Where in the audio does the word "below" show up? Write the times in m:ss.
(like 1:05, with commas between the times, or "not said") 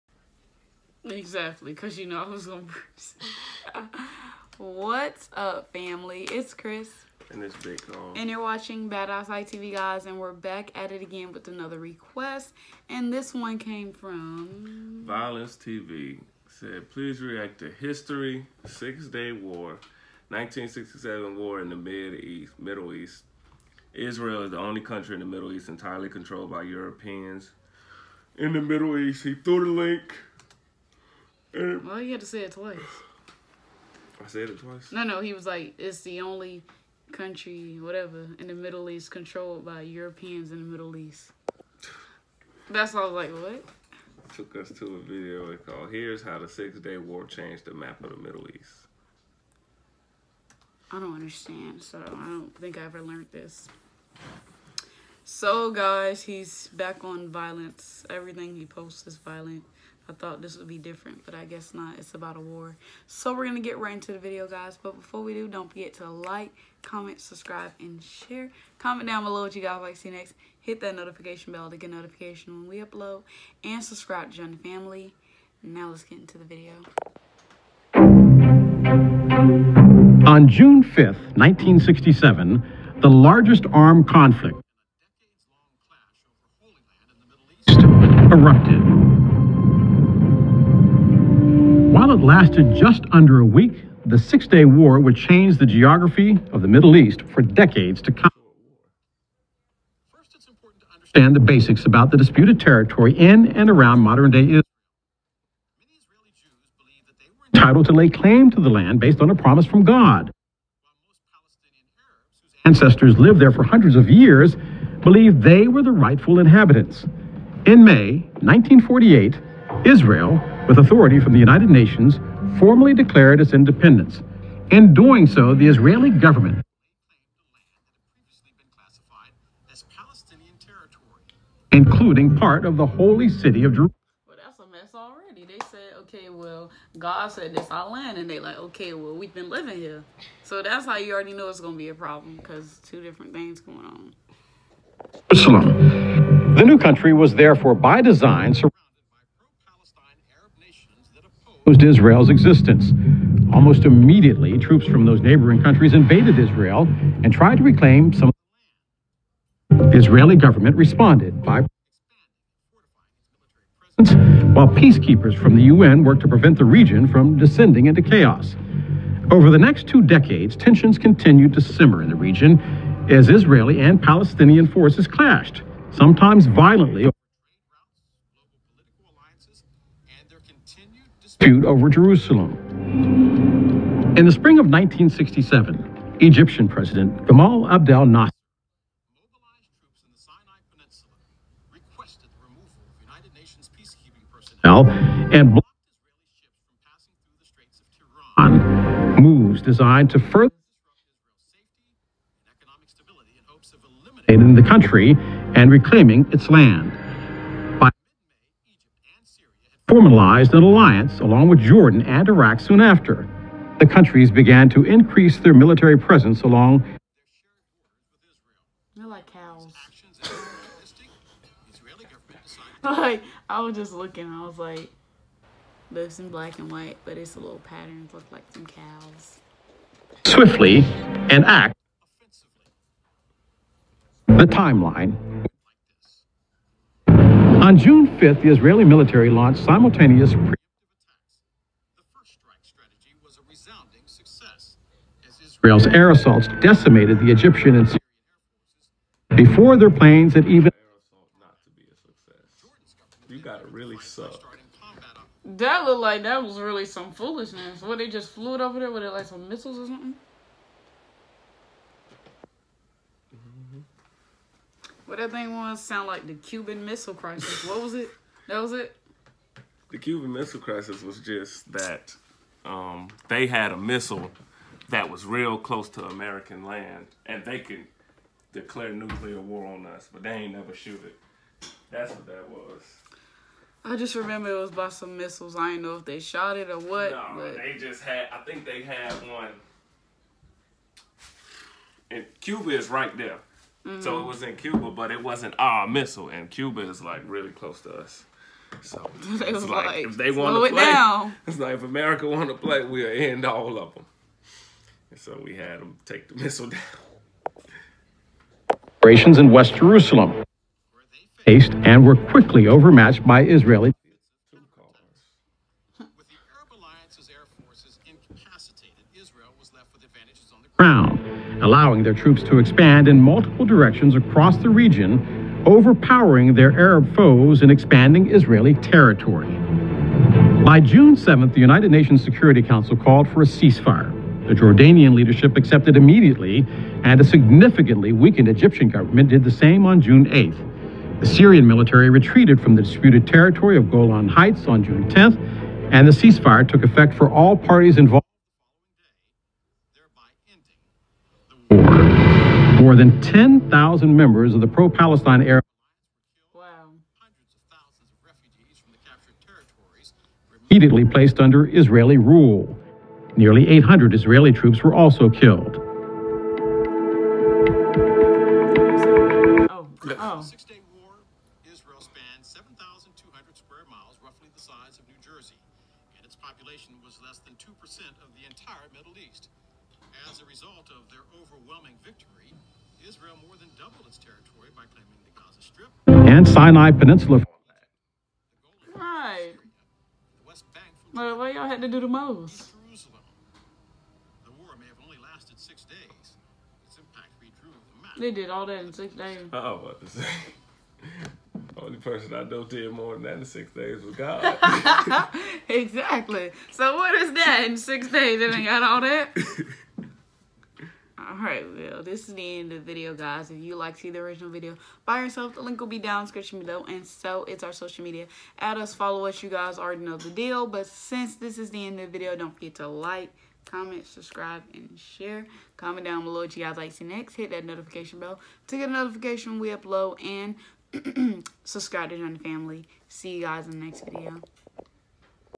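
1:09, 6:56, 7:06.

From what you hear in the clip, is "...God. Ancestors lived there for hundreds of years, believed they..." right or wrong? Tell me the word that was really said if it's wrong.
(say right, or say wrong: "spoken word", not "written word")
right.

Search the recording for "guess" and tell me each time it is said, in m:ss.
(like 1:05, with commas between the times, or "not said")
1:01.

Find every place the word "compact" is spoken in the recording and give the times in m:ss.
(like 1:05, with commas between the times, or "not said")
not said.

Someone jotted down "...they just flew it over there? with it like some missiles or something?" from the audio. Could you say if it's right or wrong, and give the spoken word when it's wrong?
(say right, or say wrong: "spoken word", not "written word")
right.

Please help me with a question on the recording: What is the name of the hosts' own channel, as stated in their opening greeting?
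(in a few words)
BadEyesight TV.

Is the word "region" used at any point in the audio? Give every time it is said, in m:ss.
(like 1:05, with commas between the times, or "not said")
2:46, 2:52, 5:24.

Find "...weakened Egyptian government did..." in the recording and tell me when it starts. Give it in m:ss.
5:38.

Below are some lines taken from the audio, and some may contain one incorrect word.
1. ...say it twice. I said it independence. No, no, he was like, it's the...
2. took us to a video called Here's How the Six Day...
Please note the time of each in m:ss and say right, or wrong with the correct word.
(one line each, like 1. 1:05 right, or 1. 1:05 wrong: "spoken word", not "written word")
1. 0:32 wrong: "twice", not "independence"
2. 0:44 right.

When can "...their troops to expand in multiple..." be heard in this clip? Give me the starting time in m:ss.
5:22.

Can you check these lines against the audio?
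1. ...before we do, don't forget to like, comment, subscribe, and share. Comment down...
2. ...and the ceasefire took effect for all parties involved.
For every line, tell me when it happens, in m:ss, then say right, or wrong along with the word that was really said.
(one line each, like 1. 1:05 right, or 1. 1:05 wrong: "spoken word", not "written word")
1. 1:04 right
2. 5:45 right.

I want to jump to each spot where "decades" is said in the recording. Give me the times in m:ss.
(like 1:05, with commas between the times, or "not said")
1:37, 2:50.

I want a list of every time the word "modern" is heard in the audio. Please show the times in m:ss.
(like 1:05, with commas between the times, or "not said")
1:43.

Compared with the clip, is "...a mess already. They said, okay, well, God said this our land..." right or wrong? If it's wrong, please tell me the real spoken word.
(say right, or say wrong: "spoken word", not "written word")
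right.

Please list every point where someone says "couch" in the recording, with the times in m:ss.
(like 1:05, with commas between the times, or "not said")
not said.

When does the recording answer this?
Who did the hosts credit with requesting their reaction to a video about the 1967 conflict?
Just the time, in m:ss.
0:15.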